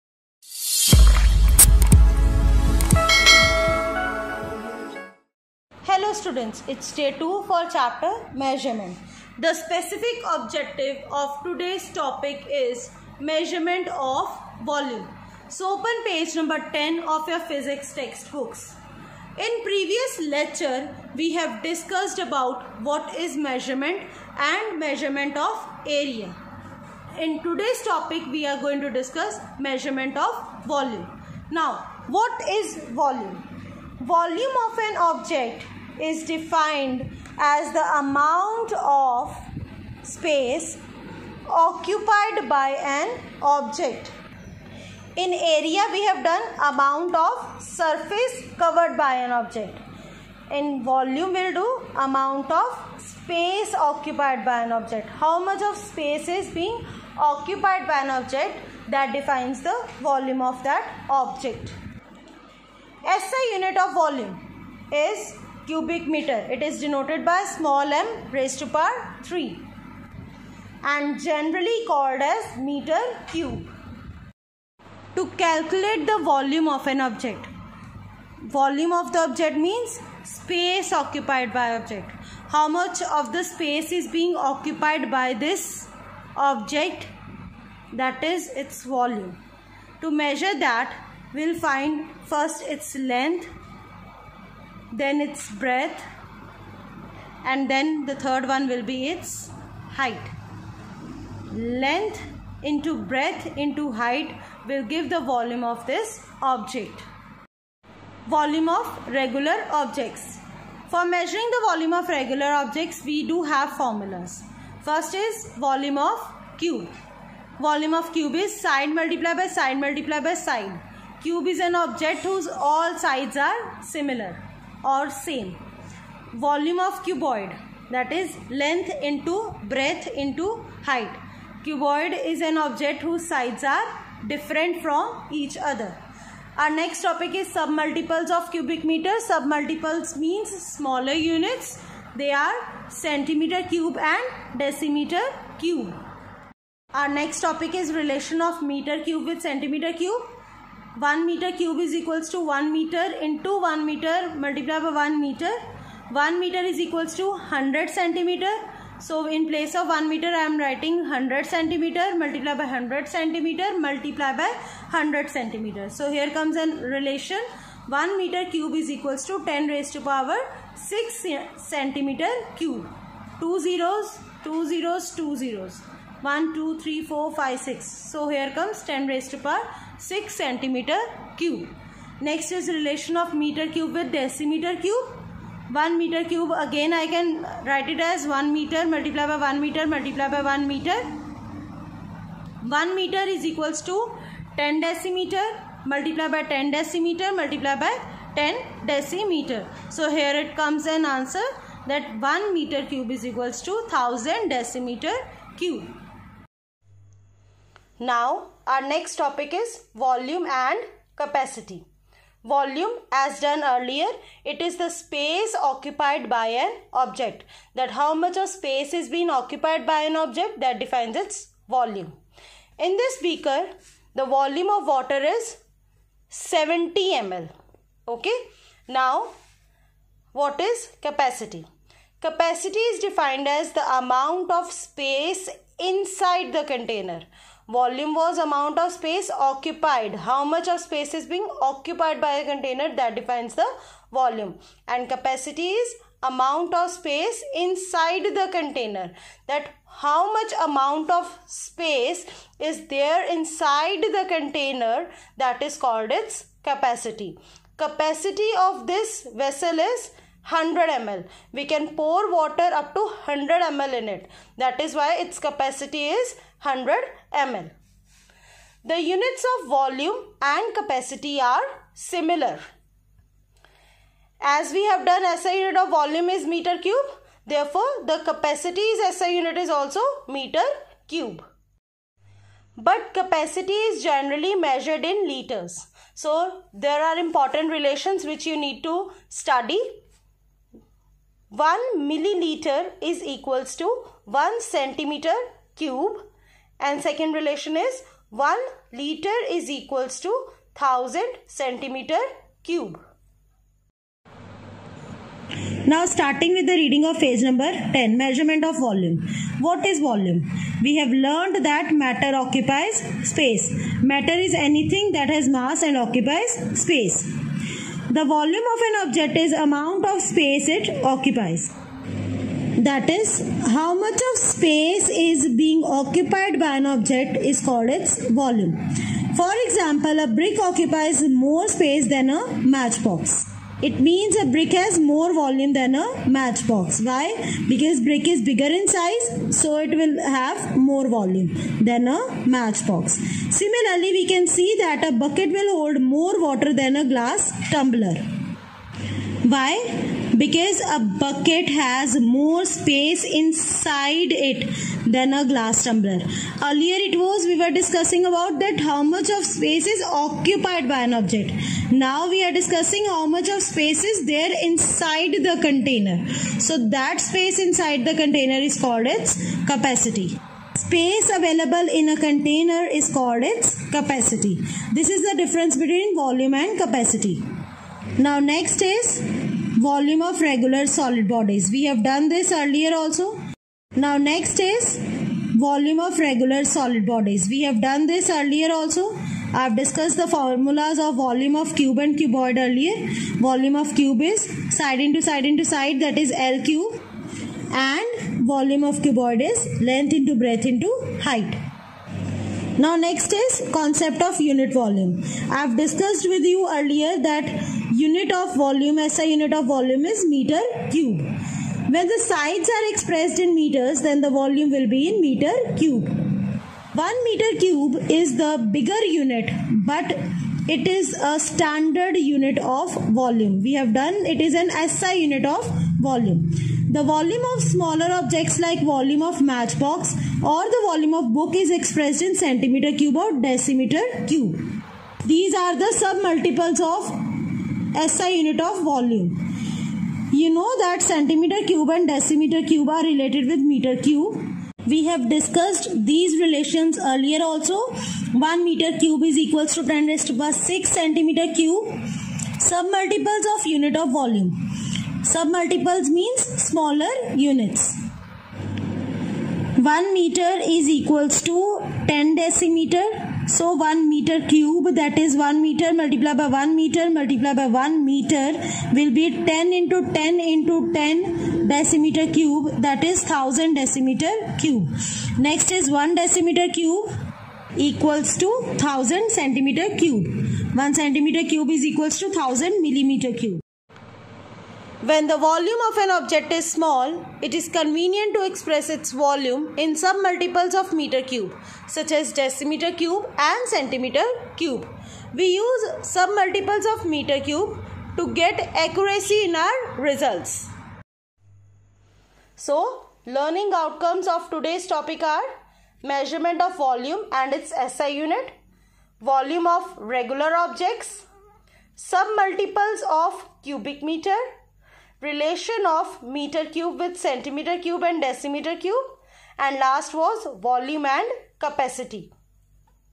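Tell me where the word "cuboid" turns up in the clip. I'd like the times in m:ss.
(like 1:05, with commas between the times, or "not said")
6:32, 6:39.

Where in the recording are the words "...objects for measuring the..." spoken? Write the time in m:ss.
1:49.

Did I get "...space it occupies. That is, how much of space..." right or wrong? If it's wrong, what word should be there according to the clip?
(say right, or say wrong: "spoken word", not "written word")
right.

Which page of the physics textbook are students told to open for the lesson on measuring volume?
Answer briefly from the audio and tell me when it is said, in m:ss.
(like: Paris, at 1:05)
10, at 0:16.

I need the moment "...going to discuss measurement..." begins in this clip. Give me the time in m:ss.
0:28.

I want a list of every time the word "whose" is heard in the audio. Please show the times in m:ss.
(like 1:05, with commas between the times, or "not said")
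2:02.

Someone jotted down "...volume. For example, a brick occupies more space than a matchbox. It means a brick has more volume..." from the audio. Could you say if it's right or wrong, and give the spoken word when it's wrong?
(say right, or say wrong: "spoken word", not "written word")
right.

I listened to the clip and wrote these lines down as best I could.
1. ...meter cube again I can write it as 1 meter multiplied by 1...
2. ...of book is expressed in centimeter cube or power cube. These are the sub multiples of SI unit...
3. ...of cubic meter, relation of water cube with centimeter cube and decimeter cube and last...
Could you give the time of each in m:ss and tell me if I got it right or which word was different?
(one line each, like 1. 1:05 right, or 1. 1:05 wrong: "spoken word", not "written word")
1. 3:05 right
2. 7:11 wrong: "decimeter", not "power"
3. 8:33 wrong: "meter", not "water".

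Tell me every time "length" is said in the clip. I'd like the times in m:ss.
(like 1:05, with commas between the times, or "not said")
1:32, 1:41, 6:39.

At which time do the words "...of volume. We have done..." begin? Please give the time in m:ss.
7:02.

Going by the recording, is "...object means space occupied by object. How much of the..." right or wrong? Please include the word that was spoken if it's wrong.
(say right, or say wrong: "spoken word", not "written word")
right.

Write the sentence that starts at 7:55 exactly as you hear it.
Next is 1 decimeter cube equals to 1000 centimeter cube.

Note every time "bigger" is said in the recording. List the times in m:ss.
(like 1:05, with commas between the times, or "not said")
5:38, 6:58.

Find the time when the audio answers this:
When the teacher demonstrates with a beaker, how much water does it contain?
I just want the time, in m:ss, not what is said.
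3:46.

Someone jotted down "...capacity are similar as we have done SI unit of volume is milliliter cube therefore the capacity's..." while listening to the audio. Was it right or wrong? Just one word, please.
wrong.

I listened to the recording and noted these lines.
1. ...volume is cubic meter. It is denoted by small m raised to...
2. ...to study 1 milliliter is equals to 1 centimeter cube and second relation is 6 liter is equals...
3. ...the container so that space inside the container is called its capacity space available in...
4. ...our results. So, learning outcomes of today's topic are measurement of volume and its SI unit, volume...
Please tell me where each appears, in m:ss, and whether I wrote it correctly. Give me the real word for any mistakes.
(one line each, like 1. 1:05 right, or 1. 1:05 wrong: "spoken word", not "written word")
1. 1:03 right
2. 4:48 wrong: "1", not "6"
3. 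6:05 right
4. 8:19 right.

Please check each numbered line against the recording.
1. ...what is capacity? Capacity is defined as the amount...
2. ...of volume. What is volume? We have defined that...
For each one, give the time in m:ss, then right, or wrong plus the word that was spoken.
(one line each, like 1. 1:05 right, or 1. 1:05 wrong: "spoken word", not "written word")
1. 3:50 right
2. 5:08 wrong: "learned", not "defined".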